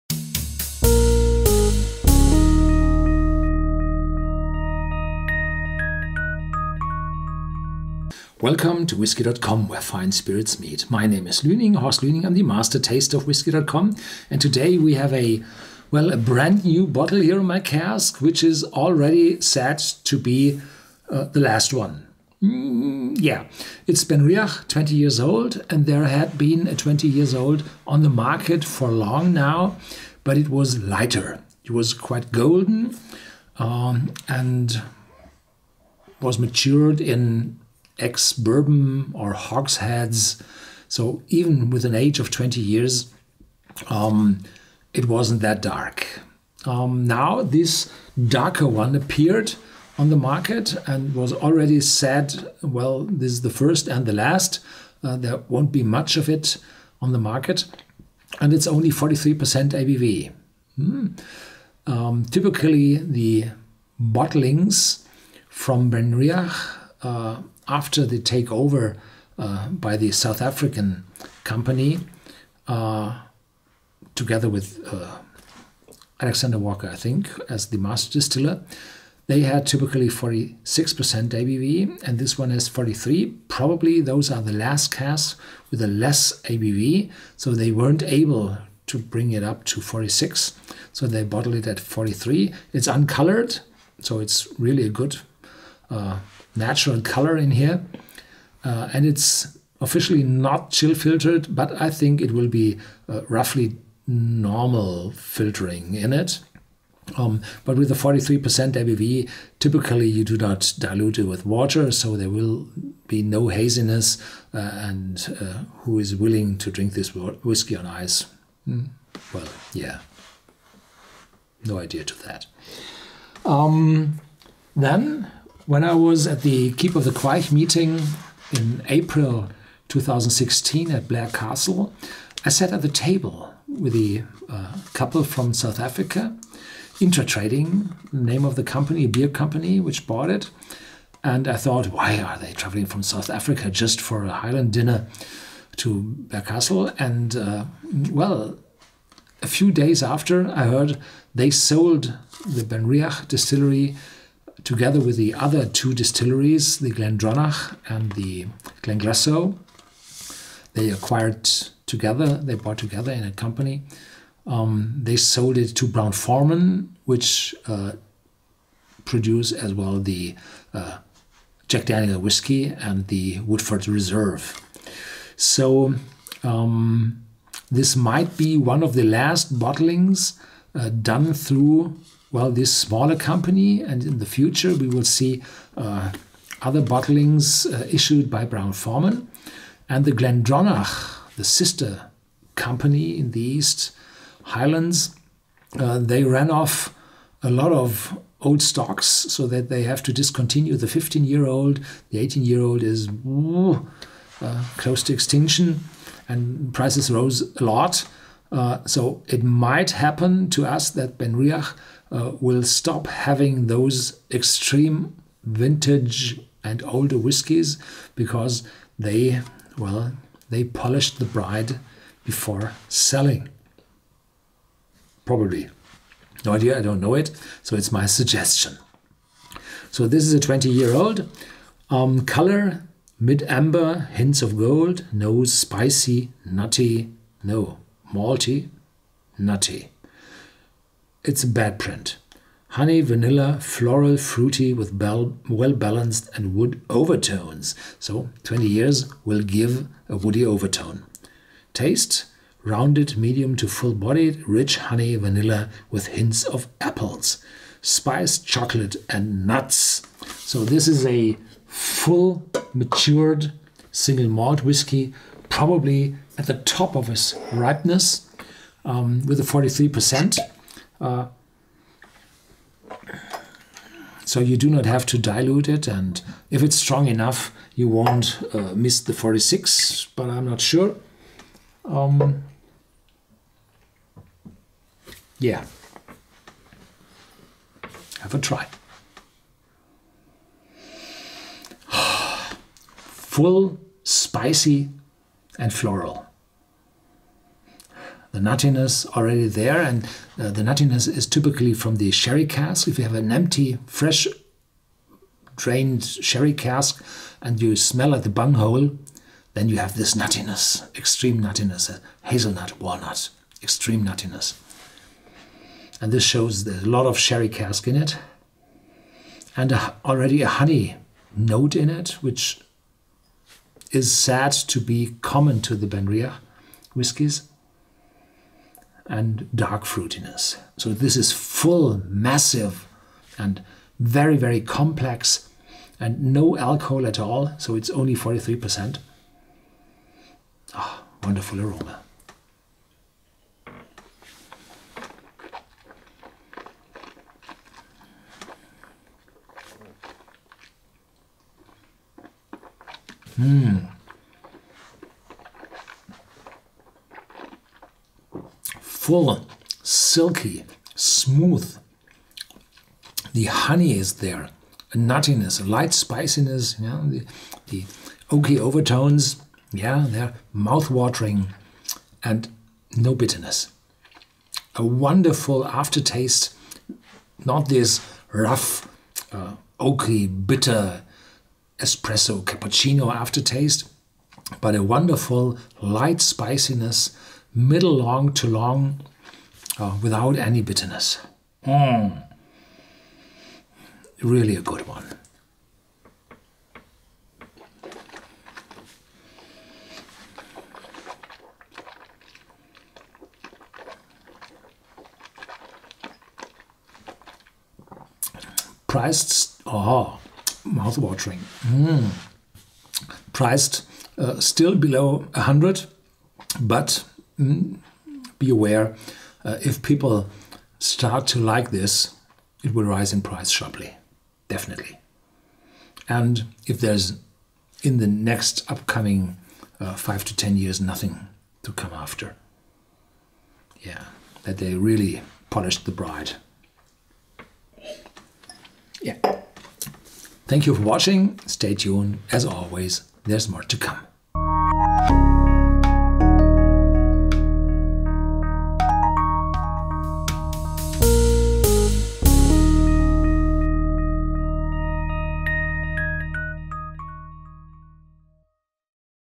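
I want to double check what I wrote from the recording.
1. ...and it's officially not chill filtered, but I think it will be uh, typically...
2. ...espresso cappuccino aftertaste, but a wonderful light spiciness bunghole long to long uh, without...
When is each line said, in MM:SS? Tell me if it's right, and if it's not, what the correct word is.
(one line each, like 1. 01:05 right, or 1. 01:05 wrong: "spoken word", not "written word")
1. 01:38 wrong: "roughly", not "typically"
2. 06:21 wrong: "middle", not "bunghole".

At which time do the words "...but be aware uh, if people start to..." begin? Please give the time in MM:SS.
06:56.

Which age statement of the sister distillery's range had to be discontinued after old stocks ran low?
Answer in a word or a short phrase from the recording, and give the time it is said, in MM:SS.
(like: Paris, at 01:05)
15-year-old, at 03:20.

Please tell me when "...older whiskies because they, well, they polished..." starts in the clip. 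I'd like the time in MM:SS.
03:36.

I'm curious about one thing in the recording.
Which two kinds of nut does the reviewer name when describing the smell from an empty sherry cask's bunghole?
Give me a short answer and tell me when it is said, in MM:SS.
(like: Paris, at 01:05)
hazelnut, walnut, at 05:12.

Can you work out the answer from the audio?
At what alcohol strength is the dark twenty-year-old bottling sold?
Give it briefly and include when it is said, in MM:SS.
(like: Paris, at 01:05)
43%, at 00:58.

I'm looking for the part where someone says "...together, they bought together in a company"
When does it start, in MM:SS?
02:41.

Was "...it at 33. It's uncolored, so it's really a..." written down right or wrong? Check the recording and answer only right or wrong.
wrong.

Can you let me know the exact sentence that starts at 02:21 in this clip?
And I thought, why are they traveling from South Africa just for a Highland dinner to Blair Castle?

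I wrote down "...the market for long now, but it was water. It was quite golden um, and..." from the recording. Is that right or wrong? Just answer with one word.
wrong.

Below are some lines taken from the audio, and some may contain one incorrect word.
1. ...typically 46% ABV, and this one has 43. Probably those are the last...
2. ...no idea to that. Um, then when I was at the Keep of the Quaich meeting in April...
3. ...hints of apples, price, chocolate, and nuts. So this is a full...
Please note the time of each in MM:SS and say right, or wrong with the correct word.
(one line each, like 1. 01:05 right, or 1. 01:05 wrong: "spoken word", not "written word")
1. 01:19 right
2. 02:01 right
3. 04:16 wrong: "spice", not "price".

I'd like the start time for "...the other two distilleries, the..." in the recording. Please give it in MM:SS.
02:35.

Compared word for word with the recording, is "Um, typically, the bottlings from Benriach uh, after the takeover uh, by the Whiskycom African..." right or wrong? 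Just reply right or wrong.
wrong.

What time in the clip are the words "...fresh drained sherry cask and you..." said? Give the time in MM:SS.
05:03.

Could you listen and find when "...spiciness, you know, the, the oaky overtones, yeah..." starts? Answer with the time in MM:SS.
06:05.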